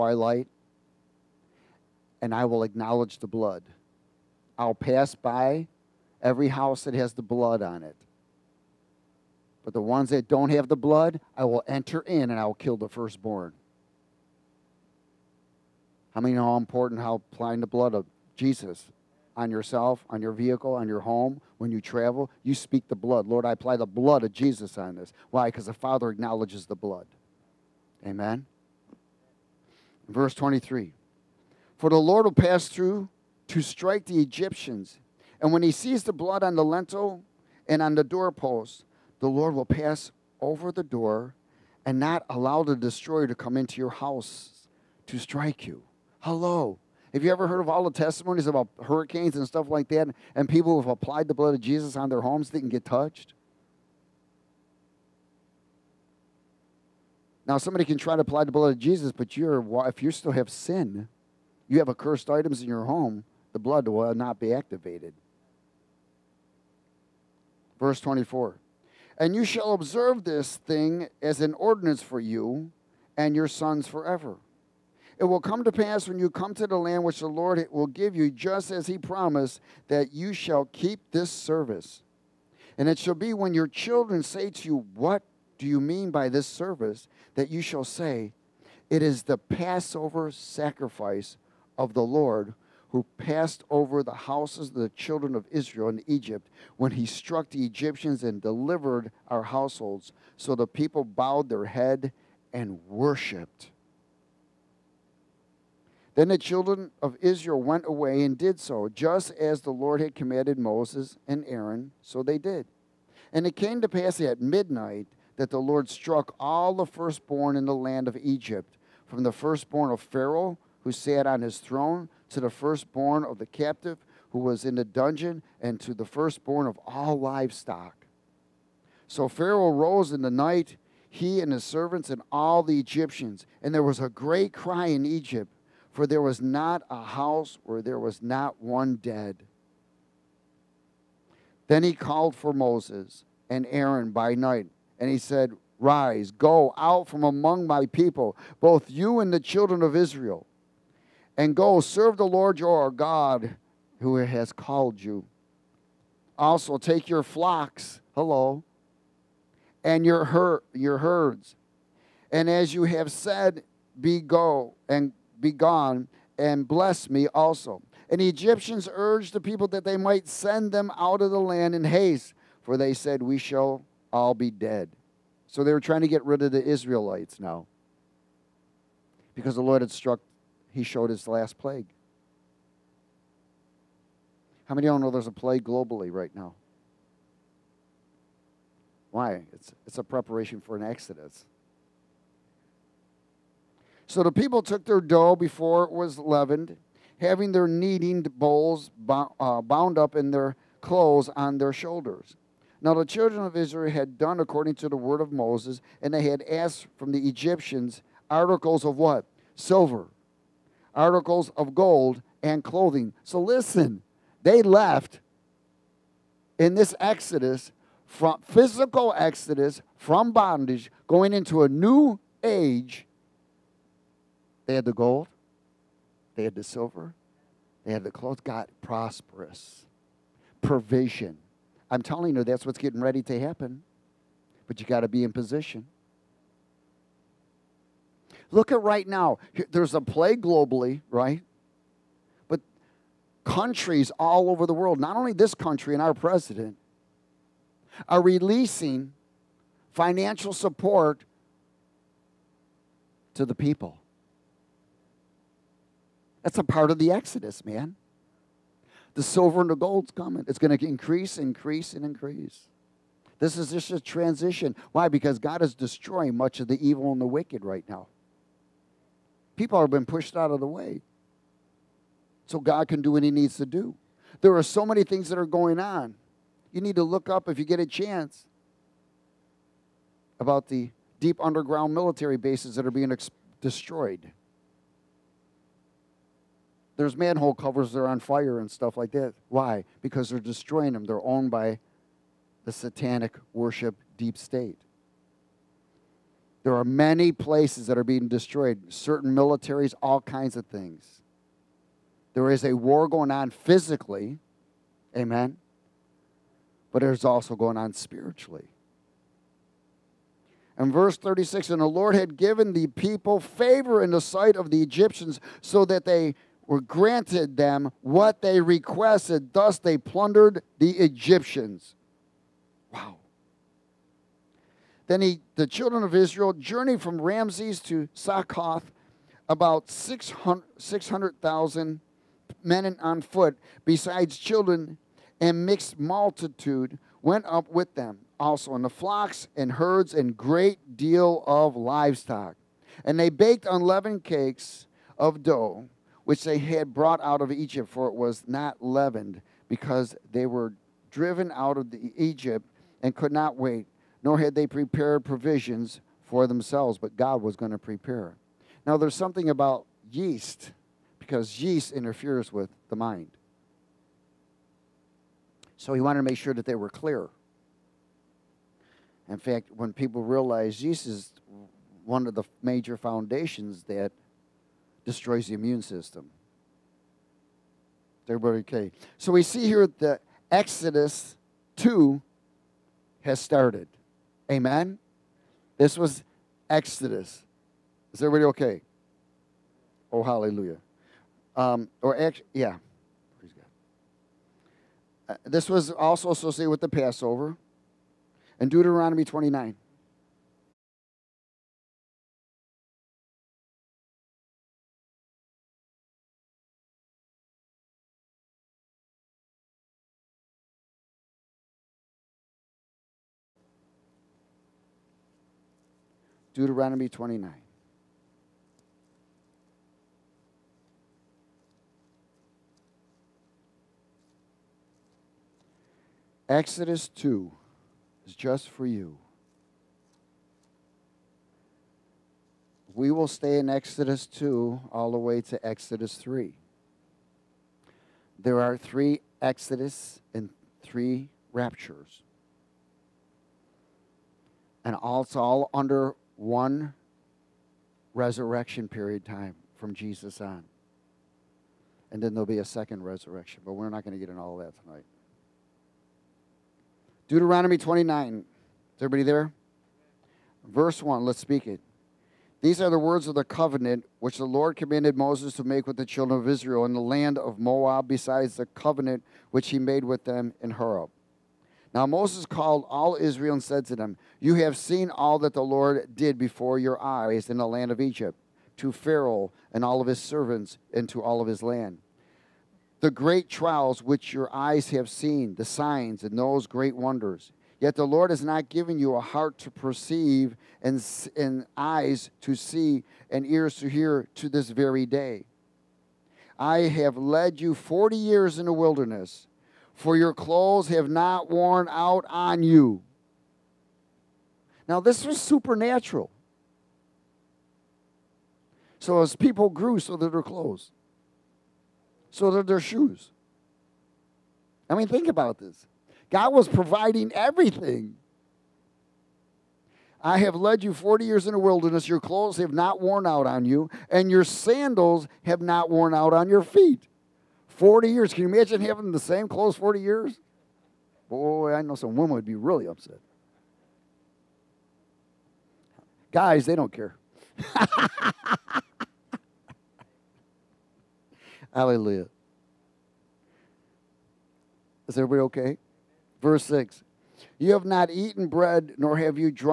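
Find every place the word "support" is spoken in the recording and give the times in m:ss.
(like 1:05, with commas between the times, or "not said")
4:10.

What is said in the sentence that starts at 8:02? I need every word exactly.
The great trials which your eyes have seen, the signs and those great wonders.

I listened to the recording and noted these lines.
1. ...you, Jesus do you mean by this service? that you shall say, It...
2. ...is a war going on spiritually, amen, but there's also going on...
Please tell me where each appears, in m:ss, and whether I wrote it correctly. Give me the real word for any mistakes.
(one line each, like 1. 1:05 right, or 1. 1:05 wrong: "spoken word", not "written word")
1. 1:24 wrong: "What", not "Jesus"
2. 5:02 wrong: "physically", not "spiritually".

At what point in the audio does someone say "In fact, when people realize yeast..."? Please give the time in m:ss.
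6:09.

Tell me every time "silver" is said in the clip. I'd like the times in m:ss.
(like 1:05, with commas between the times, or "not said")
3:29, 3:46, 4:19.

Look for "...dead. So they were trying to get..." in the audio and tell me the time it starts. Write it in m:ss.
2:54.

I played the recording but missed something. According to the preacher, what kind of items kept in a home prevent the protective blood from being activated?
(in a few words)
accursed items.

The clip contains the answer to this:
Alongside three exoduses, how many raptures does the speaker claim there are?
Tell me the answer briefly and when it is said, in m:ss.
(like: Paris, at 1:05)
3, at 7:20.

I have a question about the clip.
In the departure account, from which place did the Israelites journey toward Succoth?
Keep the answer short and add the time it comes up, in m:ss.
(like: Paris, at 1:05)
Ramses, at 5:27.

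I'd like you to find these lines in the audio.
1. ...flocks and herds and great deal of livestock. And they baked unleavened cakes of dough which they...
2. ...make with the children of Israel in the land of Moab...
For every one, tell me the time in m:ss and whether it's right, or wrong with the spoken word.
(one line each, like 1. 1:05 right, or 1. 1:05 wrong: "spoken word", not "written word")
1. 5:38 right
2. 7:45 right.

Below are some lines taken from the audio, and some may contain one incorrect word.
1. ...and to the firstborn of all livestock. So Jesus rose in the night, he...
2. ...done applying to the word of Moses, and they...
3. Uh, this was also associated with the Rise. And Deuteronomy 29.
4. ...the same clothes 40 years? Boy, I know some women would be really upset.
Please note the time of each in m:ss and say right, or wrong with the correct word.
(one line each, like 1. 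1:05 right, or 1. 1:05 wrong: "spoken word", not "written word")
1. 2:05 wrong: "Pharaoh", not "Jesus"
2. 3:24 wrong: "according", not "applying"
3. 6:35 wrong: "Passover", not "Rise"
4. 8:49 right.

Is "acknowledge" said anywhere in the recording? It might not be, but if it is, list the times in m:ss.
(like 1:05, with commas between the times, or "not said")
0:02, 0:26.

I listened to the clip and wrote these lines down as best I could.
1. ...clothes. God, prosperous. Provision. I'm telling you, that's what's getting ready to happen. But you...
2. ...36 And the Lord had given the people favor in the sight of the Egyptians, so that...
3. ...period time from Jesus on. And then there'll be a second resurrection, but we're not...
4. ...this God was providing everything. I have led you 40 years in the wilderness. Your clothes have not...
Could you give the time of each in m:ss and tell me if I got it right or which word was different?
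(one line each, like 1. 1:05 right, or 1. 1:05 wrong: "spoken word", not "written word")
1. 3:48 right
2. 5:11 right
3. 7:28 right
4. 8:35 right.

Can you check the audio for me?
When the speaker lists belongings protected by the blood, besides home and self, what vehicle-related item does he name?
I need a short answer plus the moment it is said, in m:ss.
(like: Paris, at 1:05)
your vehicle, at 0:20.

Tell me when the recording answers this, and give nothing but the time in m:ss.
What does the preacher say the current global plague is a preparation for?
3:09.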